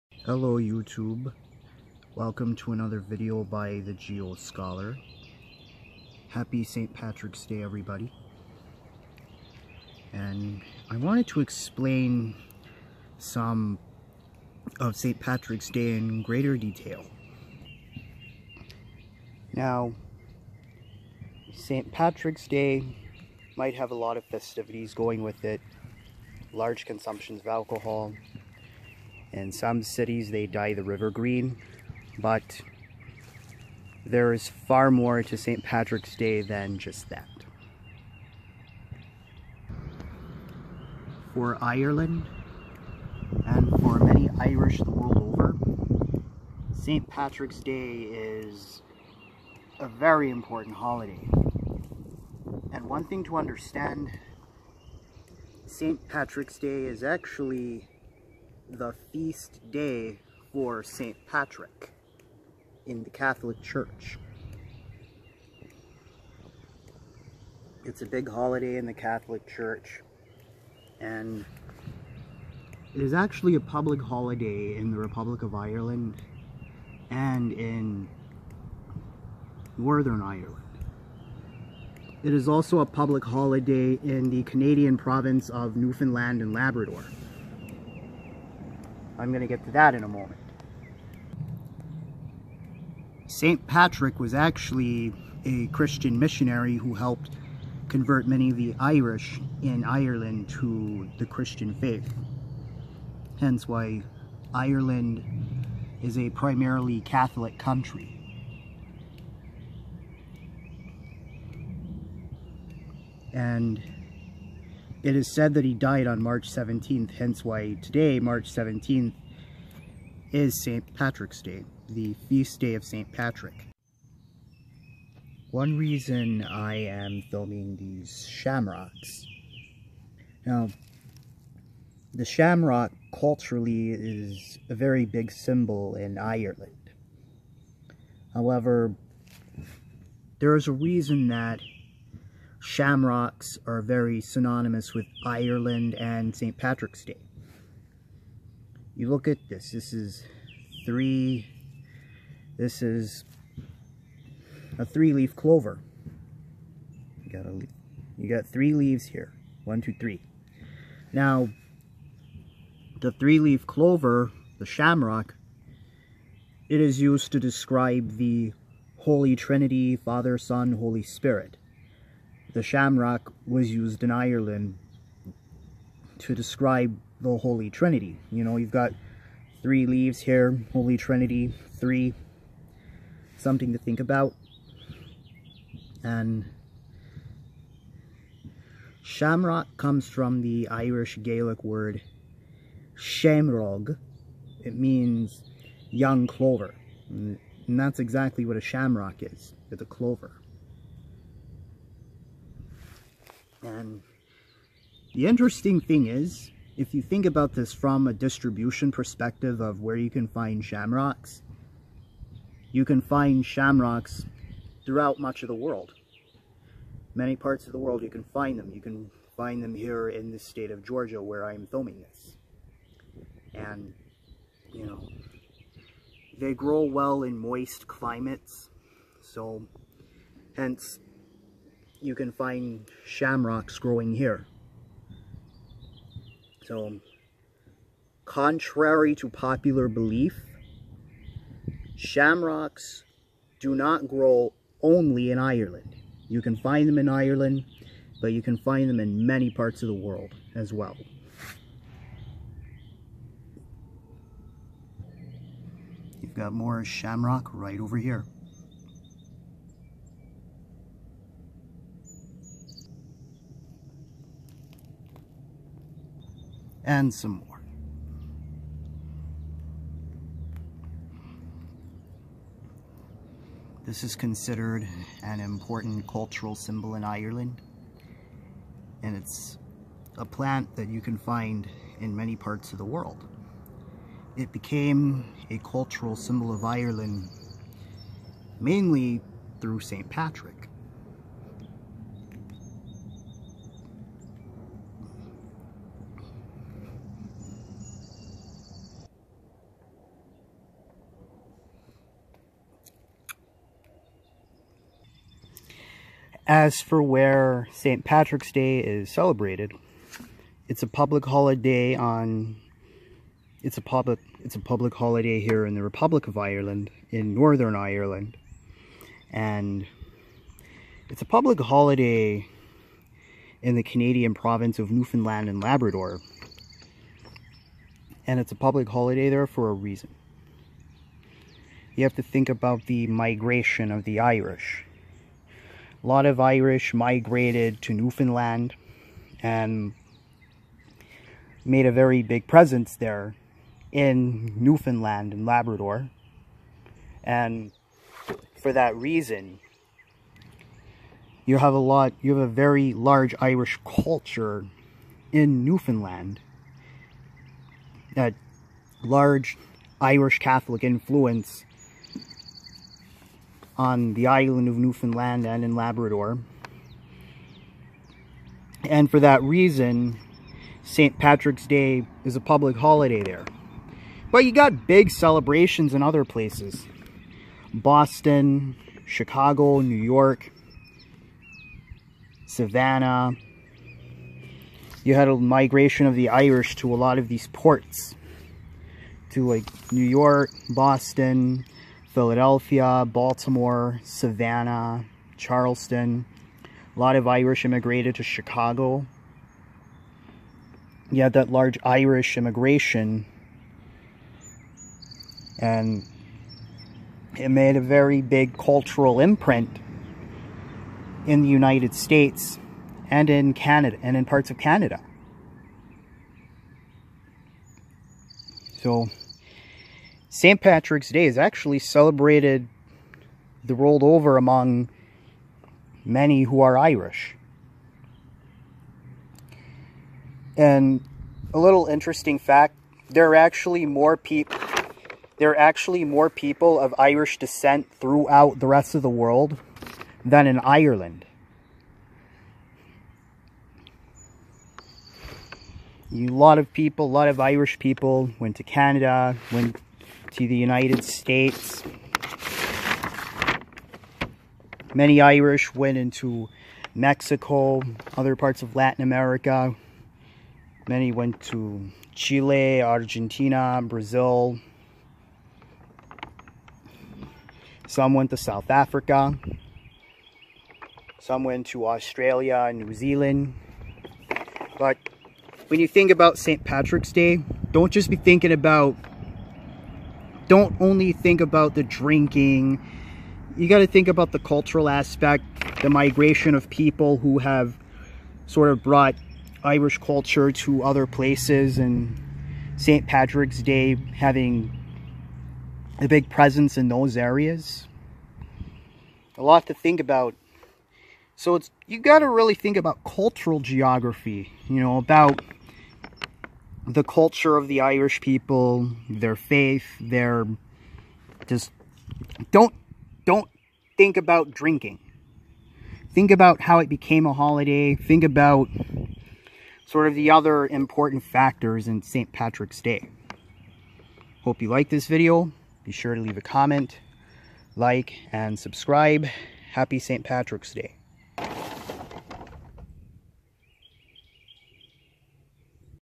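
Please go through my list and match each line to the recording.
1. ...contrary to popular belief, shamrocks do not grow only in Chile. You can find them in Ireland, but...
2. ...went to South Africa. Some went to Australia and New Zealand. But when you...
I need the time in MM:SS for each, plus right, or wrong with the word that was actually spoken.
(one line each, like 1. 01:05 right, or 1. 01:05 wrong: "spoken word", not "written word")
1. 03:58 wrong: "Ireland", not "Chile"
2. 07:48 right.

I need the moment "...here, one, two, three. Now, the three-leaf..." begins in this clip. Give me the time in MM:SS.
02:39.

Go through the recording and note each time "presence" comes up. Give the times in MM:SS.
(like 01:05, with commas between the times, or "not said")
05:42, 08:16.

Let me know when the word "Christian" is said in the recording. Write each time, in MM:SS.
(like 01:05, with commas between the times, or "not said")
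01:35, 01:41.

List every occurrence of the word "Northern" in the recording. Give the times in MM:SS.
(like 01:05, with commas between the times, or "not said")
01:19, 05:17.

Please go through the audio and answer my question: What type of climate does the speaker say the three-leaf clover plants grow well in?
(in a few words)
moist climates.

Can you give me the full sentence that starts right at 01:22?
It is also a public holiday in the Canadian province of Newfoundland and Labrador.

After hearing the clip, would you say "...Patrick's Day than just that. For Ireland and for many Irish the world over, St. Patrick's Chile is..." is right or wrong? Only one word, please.
wrong.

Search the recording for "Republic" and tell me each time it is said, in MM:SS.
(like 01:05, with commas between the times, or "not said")
01:14, 05:15.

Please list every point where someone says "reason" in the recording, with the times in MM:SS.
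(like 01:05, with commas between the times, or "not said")
02:05, 02:20, 05:29, 05:48, 06:09.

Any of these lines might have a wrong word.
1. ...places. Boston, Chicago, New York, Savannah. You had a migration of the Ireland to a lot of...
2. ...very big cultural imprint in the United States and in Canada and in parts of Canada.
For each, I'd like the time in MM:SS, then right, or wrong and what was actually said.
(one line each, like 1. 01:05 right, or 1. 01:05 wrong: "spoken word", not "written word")
1. 06:16 wrong: "Irish", not "Ireland"
2. 06:47 right.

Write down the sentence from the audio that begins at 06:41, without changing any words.
You had that large Irish immigration.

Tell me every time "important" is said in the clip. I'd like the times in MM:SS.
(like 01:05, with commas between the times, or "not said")
00:50, 04:35, 08:40.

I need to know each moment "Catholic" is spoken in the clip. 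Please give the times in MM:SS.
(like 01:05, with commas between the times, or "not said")
01:03, 01:08, 01:47, 06:00.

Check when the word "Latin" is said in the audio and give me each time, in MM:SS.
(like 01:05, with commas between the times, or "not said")
07:38.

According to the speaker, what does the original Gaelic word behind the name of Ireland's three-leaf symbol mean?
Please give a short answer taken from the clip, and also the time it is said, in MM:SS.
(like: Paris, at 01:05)
young clover, at 03:15.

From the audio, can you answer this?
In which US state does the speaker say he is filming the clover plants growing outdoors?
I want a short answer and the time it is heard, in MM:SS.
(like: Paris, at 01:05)
Georgia, at 03:40.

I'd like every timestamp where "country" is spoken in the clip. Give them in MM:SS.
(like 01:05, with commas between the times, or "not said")
01:47.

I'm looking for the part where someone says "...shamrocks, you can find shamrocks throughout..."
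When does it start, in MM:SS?
03:30.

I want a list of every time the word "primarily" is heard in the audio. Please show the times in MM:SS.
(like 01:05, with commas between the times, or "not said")
01:46.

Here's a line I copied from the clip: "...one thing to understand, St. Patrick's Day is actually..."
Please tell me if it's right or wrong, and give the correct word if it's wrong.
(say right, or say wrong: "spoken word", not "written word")
right.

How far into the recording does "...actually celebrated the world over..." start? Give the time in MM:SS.
07:01.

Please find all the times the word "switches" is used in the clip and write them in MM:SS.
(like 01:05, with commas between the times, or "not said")
not said.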